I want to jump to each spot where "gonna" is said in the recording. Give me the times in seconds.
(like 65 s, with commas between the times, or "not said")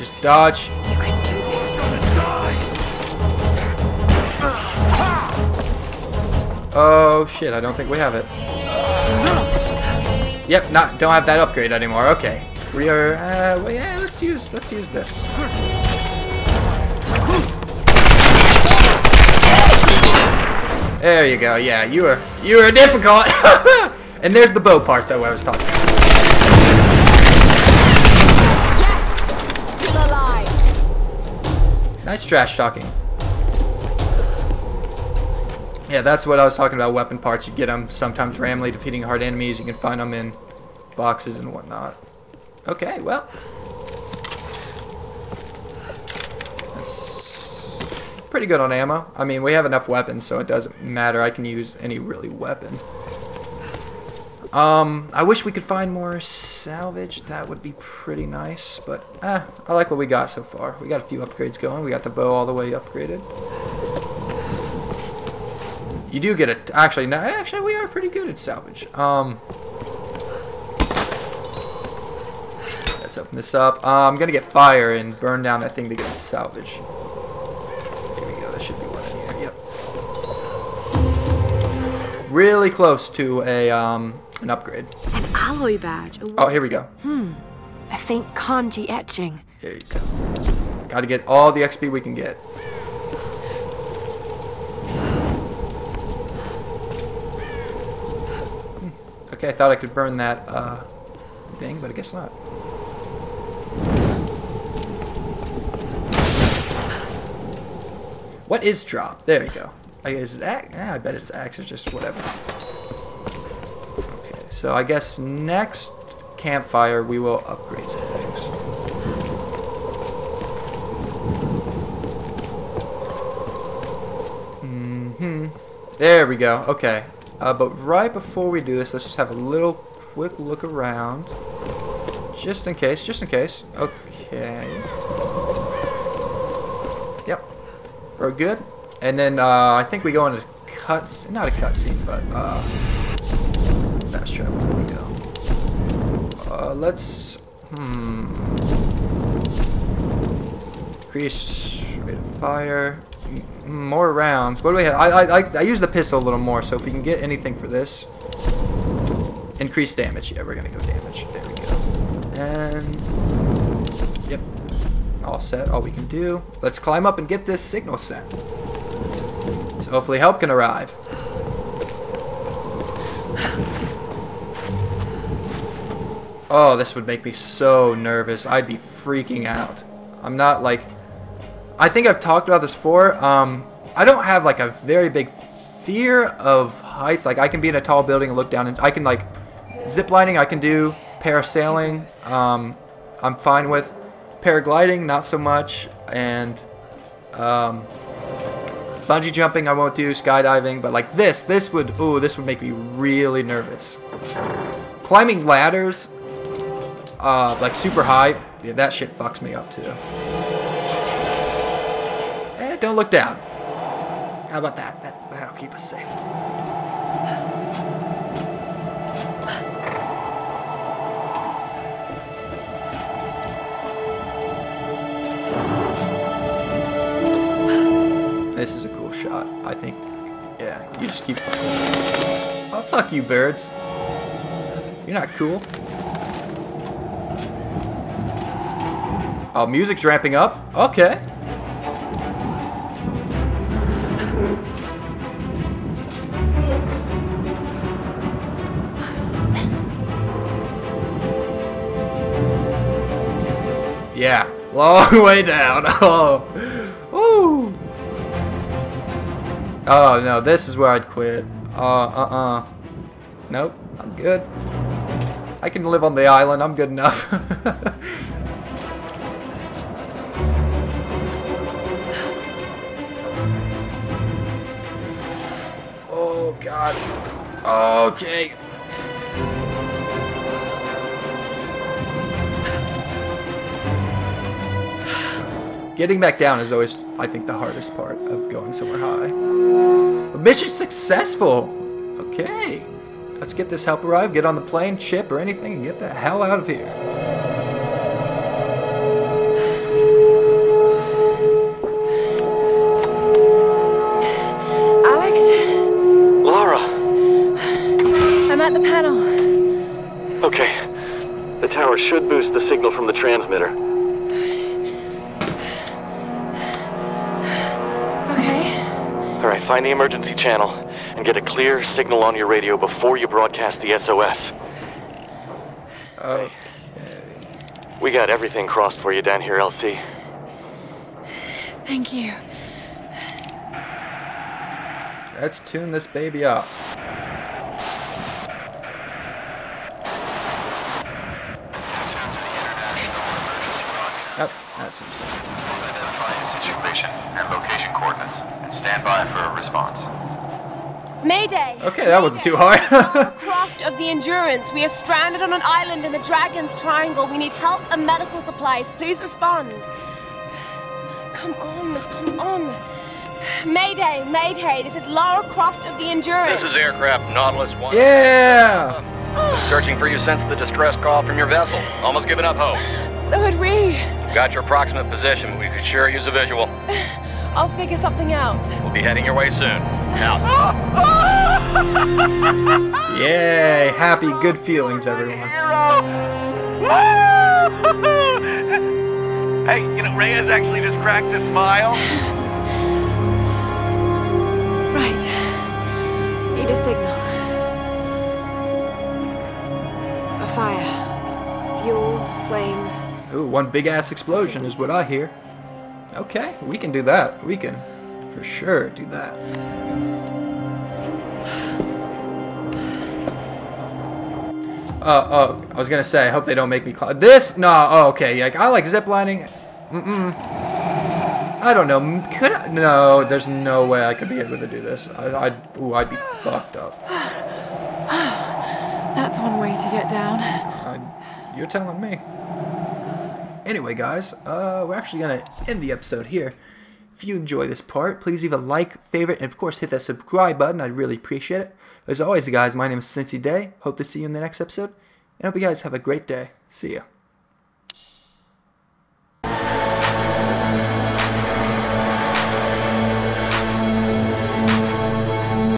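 74 s, 415 s.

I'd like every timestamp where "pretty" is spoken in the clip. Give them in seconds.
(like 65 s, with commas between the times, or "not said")
48 s, 57 s, 67 s.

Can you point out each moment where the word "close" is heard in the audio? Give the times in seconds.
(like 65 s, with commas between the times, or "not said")
82 s.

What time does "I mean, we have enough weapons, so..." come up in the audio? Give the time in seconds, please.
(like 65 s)
49 s.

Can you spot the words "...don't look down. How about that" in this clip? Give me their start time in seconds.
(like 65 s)
212 s.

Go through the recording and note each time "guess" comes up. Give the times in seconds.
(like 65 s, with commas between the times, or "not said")
101 s, 114 s.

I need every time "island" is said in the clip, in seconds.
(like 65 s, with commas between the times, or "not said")
266 s, 355 s.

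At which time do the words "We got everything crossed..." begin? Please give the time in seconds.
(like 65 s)
327 s.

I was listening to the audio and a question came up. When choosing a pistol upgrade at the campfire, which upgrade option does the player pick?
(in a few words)
increased damage.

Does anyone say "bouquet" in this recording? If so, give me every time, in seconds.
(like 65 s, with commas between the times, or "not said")
not said.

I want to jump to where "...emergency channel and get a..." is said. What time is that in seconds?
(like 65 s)
319 s.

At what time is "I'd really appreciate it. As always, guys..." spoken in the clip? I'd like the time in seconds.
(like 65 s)
440 s.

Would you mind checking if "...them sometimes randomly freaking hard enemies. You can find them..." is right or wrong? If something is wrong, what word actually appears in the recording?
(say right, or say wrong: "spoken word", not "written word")
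wrong: "defeating", not "freaking".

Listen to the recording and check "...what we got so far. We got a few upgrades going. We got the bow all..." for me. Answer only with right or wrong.
right.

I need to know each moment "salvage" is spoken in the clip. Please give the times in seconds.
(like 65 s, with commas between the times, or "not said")
56 s, 68 s, 76 s.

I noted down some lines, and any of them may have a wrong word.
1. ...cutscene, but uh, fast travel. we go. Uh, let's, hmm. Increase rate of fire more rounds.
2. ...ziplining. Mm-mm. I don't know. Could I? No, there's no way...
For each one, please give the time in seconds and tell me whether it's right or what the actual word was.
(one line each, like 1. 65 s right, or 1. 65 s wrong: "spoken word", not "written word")
1. 141 s right
2. 418 s right.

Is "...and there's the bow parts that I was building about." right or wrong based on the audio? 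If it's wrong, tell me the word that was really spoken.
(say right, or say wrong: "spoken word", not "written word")
wrong: "talking", not "building".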